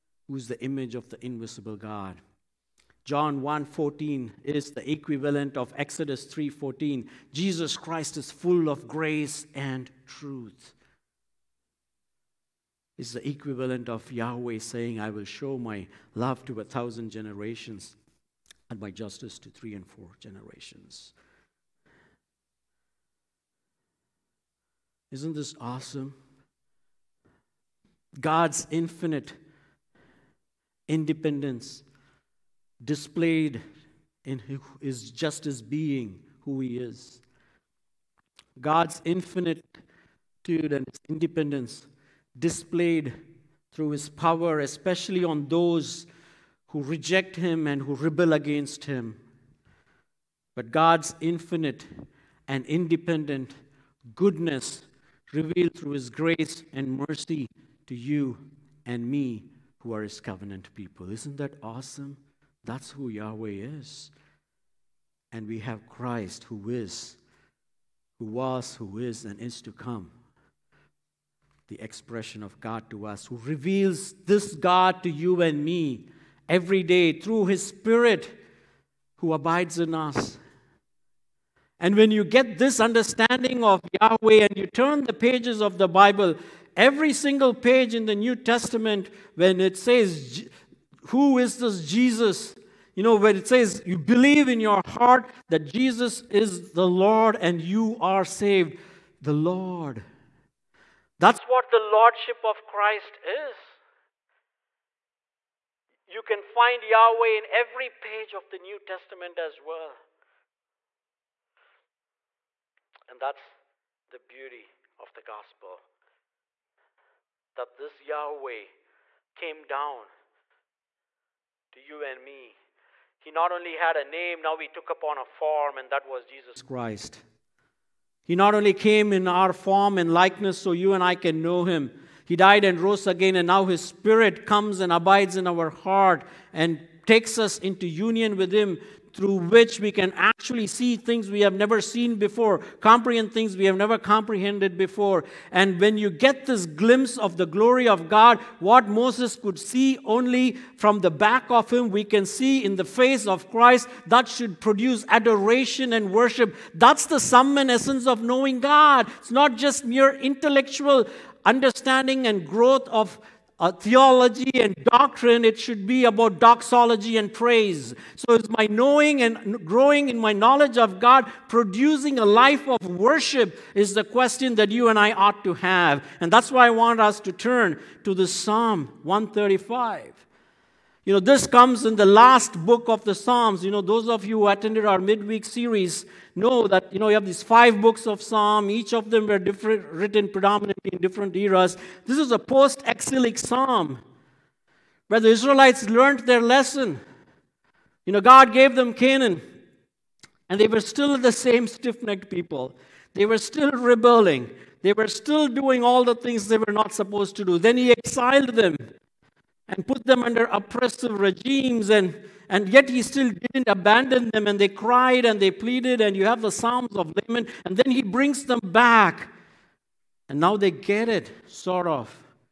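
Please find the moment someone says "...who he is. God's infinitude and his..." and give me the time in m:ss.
0:36.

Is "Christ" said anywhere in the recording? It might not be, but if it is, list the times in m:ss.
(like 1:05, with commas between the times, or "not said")
0:07, 1:05, 1:42, 2:06, 2:33.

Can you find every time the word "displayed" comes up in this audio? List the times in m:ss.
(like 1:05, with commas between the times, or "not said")
0:32, 0:42.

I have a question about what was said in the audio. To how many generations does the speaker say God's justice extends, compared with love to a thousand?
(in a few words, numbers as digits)
3 and 4.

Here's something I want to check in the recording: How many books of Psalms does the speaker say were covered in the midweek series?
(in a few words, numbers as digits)
5.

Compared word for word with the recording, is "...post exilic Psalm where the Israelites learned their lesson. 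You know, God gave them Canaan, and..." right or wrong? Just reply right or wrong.
right.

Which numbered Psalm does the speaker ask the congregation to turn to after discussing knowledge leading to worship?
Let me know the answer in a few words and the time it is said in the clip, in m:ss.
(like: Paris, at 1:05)
Psalm 135, at 2:58.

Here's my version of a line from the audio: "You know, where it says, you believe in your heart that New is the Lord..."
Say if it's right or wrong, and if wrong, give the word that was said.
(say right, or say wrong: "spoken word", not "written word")
wrong: "Jesus", not "New".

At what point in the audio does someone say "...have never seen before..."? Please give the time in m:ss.
2:21.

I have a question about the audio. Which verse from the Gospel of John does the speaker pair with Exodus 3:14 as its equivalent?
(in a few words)
John 1:14.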